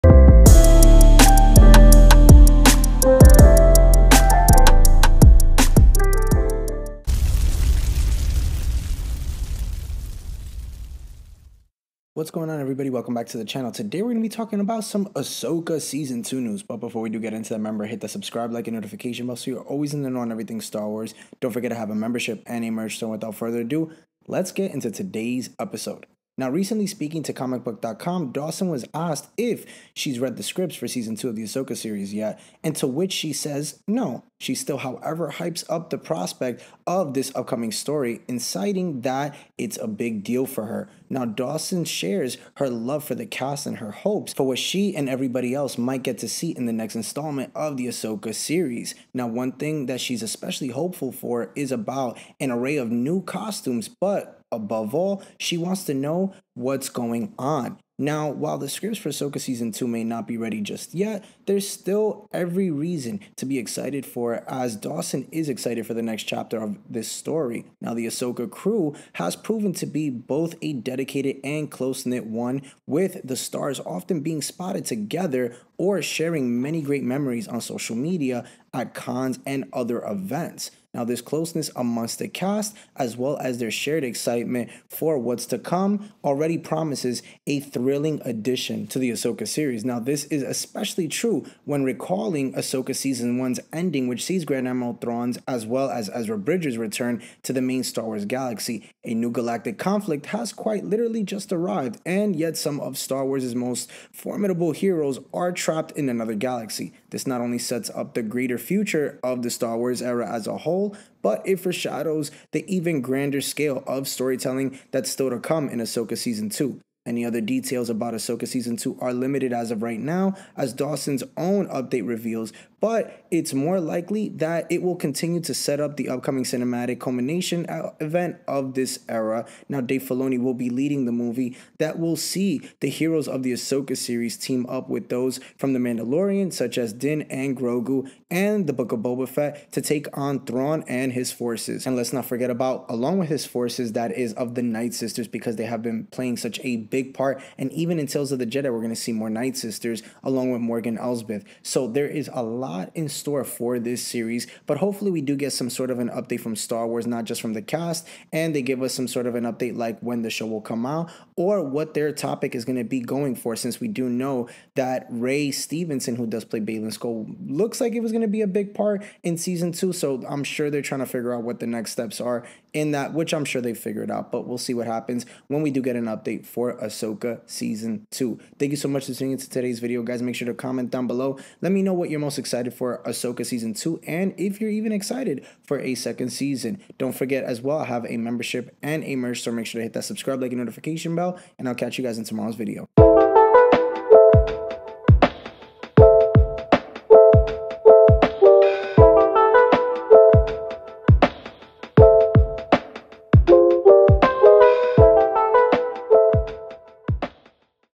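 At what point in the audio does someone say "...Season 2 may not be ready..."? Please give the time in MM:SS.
00:59.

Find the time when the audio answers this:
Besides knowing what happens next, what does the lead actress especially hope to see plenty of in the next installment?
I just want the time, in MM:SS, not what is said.
00:52.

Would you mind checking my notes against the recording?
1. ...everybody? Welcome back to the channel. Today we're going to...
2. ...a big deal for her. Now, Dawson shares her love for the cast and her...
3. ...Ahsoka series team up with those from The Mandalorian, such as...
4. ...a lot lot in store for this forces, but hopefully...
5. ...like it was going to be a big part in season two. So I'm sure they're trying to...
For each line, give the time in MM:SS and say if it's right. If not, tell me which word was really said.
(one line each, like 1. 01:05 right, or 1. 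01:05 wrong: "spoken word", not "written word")
1. 00:12 right
2. 00:39 right
3. 02:13 right
4. 02:32 wrong: "series", not "forces"
5. 02:47 right.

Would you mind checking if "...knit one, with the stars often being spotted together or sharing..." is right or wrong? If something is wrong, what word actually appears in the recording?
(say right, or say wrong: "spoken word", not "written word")
right.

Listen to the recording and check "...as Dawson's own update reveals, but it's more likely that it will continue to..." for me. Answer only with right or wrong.
right.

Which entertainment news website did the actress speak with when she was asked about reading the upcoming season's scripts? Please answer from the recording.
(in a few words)
comicbook.com.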